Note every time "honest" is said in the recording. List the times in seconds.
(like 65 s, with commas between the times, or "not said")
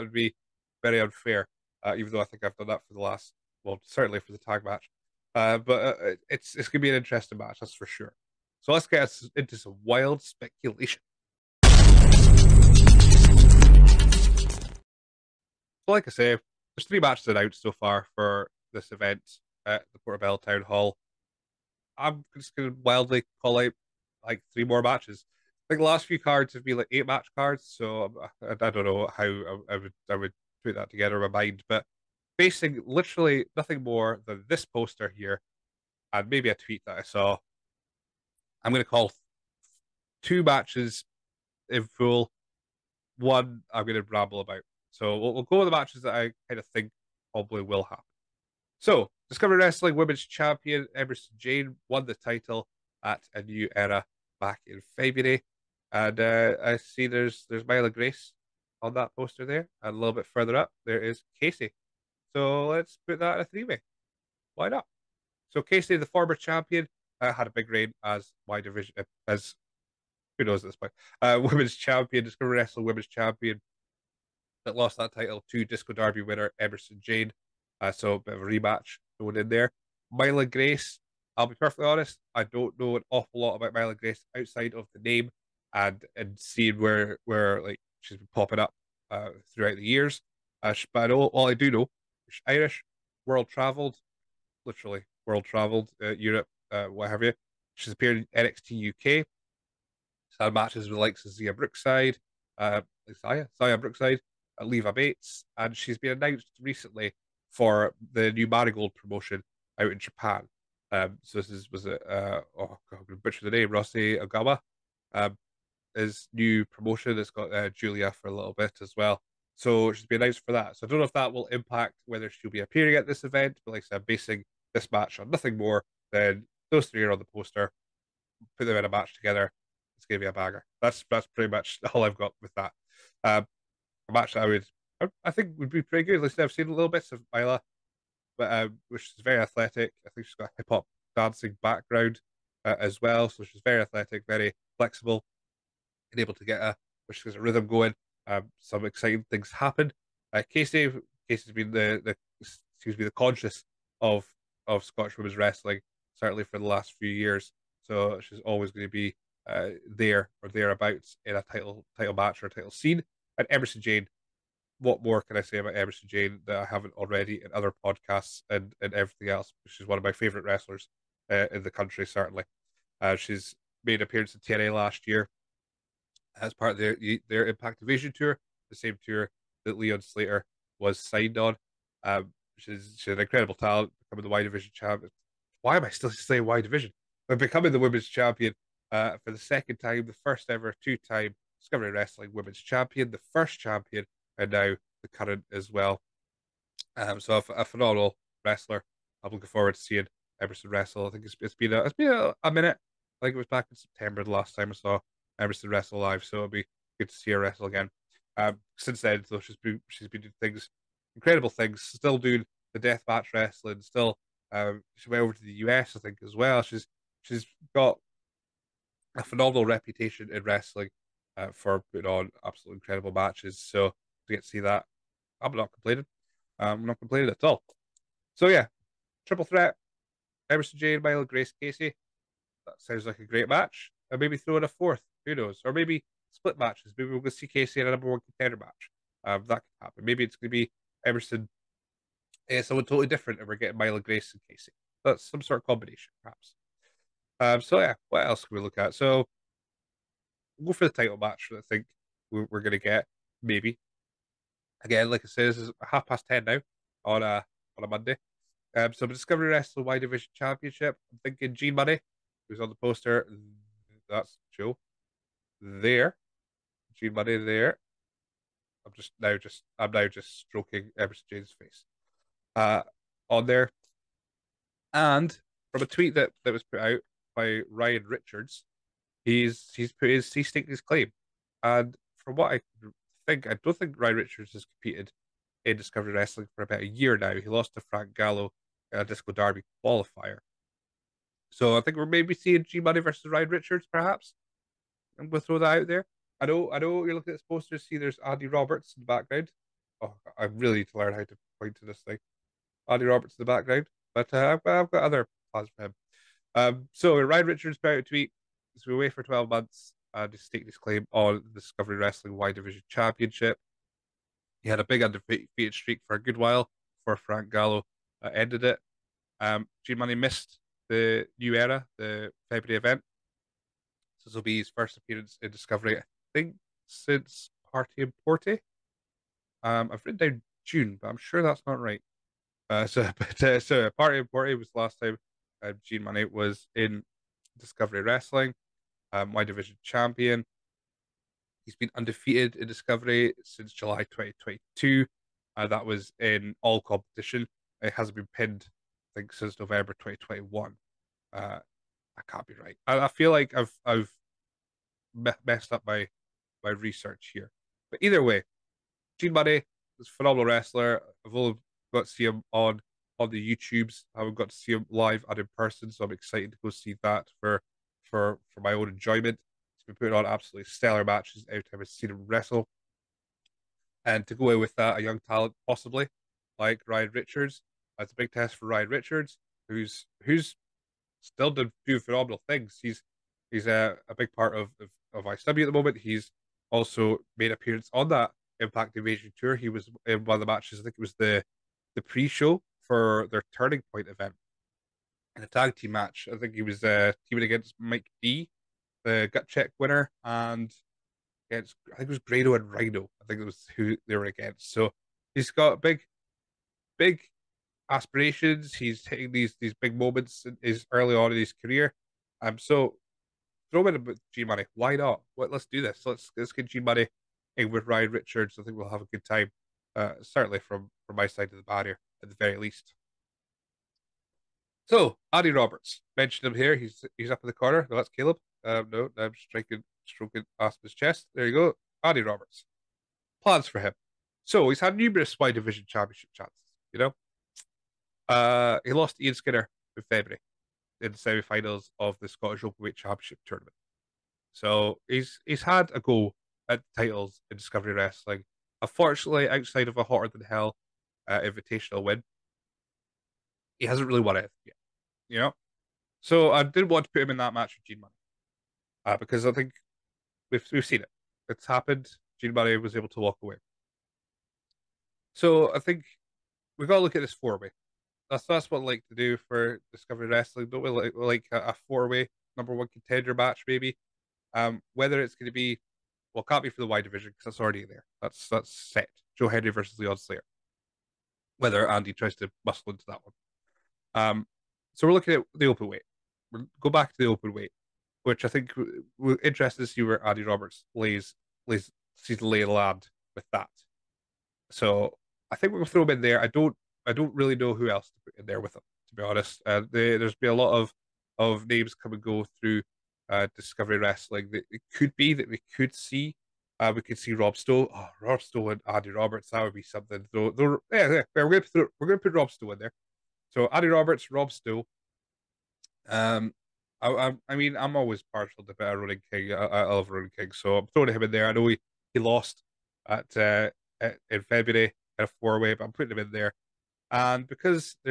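81 s, 499 s.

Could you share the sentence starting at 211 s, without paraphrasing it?
Still doing the death match wrestling.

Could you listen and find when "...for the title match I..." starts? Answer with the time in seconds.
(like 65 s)
250 s.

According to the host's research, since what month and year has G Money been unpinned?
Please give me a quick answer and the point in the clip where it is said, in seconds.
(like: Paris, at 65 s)
November 2021, at 349 s.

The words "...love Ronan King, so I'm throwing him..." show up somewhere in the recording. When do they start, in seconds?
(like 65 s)
519 s.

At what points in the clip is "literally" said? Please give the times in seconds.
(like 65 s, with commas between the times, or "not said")
32 s, 94 s.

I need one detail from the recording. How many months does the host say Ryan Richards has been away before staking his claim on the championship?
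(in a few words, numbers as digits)
12.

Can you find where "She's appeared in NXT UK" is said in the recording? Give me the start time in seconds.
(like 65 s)
97 s.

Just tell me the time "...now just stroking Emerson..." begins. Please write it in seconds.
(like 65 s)
269 s.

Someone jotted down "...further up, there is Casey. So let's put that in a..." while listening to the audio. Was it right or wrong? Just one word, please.
right.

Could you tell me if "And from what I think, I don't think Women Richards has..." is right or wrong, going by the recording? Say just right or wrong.
wrong.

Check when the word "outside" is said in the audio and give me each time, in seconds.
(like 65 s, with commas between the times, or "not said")
84 s, 449 s.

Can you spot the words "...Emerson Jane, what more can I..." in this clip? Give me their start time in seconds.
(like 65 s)
163 s.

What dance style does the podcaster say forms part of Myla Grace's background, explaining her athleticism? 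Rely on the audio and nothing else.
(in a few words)
hip hop.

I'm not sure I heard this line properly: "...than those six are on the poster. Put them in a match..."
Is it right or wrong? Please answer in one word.
wrong.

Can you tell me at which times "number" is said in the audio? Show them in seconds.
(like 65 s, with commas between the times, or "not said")
237 s, 472 s.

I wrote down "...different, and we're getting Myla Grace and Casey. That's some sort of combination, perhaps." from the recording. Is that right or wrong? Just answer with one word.
right.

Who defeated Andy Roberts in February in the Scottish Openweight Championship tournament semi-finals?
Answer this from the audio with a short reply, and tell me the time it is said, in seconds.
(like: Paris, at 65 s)
Ian Skinner, at 439 s.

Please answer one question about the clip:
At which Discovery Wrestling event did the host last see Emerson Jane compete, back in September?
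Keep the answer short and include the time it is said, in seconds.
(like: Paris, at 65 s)
Wrestle Live, at 205 s.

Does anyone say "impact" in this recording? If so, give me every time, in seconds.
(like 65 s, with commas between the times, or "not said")
121 s, 177 s, 388 s.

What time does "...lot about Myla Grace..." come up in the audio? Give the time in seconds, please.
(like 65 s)
83 s.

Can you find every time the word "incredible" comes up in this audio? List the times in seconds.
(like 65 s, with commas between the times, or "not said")
183 s, 211 s, 222 s.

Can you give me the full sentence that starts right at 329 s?
Um, I've written down June, but I'm sure that's not right.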